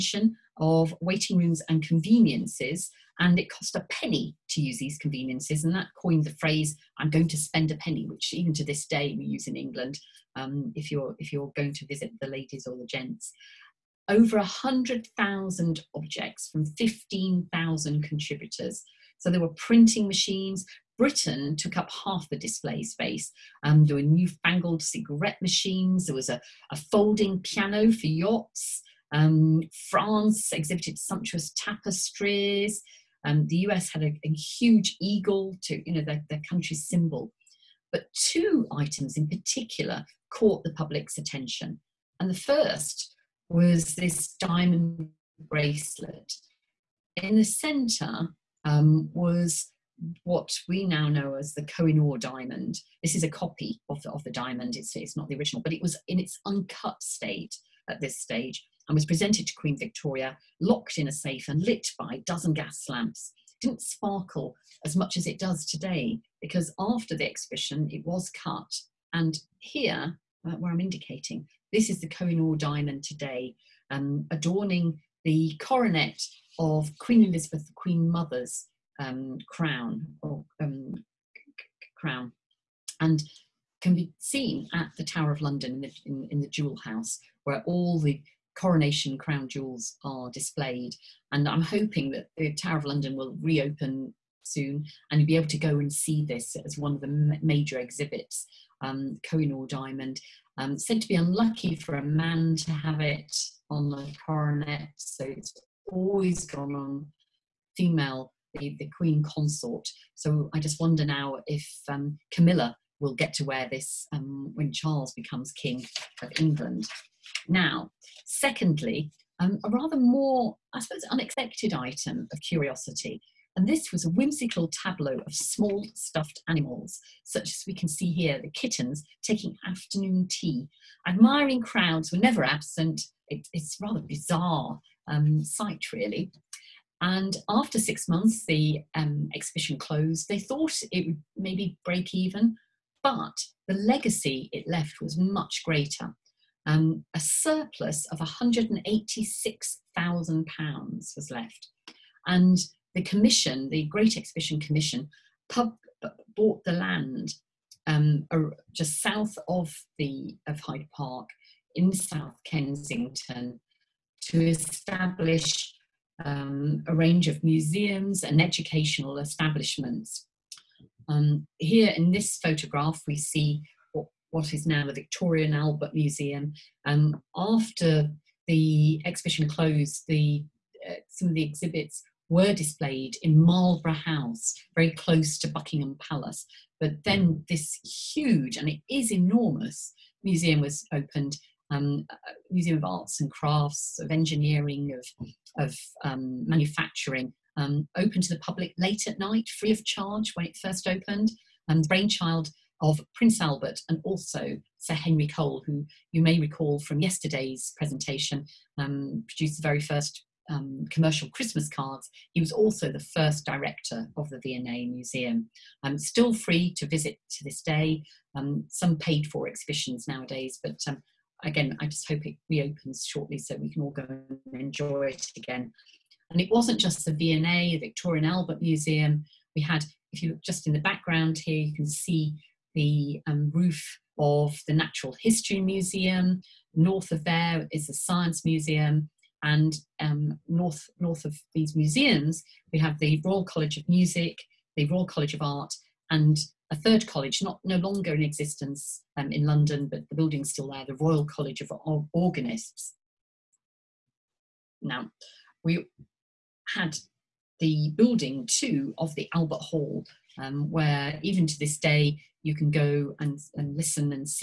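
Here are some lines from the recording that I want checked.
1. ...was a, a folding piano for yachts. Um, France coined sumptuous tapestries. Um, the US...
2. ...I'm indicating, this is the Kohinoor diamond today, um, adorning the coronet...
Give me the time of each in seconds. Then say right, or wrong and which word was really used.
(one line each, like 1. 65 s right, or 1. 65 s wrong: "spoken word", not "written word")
1. 26 s wrong: "exhibited", not "coined"
2. 70 s right.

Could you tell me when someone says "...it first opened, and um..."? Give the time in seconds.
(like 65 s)
200 s.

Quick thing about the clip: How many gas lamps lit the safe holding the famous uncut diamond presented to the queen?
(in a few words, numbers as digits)
a dozen.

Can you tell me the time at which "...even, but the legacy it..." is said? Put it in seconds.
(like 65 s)
142 s.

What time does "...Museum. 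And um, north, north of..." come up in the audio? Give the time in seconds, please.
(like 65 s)
238 s.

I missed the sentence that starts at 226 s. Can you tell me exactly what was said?
And it wasn't just the V&A, the Victoria and Albert Museum.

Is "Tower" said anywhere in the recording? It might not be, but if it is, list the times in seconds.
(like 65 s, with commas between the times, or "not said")
85 s, 92 s.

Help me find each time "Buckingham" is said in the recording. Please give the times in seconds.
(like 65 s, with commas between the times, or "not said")
185 s.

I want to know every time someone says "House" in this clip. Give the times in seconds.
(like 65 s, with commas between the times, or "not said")
86 s, 183 s.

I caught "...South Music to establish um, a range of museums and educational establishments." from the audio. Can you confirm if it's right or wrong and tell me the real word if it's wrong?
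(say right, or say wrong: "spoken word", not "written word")
wrong: "Kensington", not "Music".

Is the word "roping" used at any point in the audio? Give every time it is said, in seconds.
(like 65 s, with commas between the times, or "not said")
not said.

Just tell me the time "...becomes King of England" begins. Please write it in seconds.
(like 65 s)
115 s.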